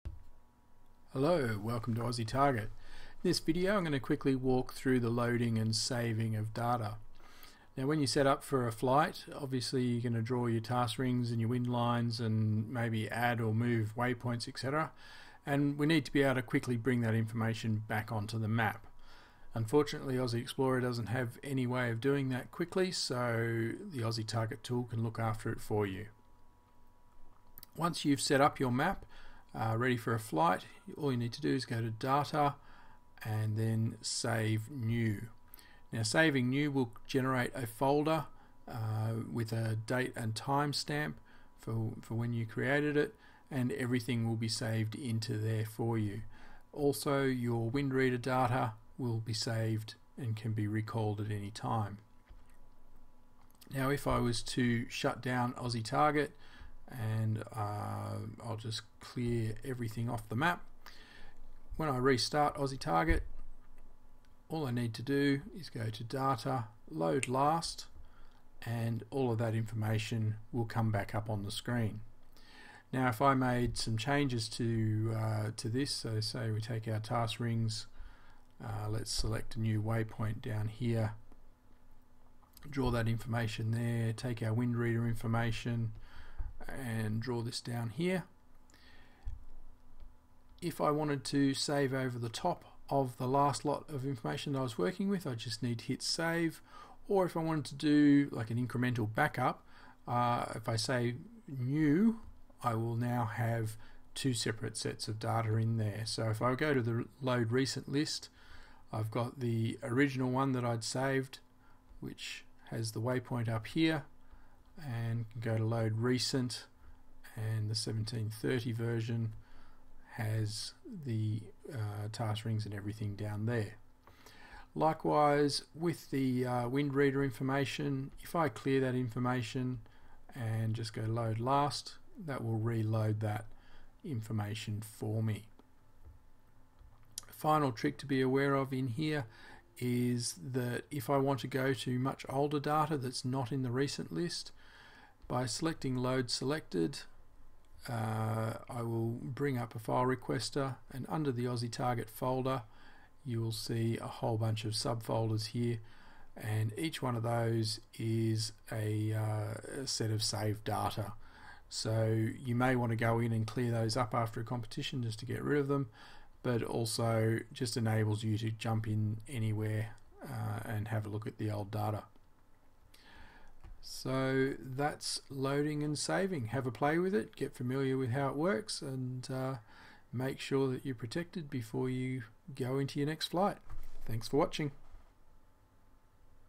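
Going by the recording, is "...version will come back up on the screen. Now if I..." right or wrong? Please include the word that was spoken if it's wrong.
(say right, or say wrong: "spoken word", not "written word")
wrong: "information", not "version".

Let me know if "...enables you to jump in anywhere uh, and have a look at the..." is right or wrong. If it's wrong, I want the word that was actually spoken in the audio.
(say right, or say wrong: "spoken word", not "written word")
right.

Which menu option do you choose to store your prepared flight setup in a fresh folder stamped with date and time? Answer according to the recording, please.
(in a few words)
Save New.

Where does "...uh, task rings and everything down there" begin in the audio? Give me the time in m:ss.
2:01.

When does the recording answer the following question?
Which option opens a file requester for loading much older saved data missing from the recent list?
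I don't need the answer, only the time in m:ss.
2:25.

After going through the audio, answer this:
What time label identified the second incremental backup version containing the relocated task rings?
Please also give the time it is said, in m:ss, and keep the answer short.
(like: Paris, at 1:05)
1730, at 1:57.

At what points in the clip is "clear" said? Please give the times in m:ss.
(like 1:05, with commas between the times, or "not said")
0:58, 2:08, 2:43.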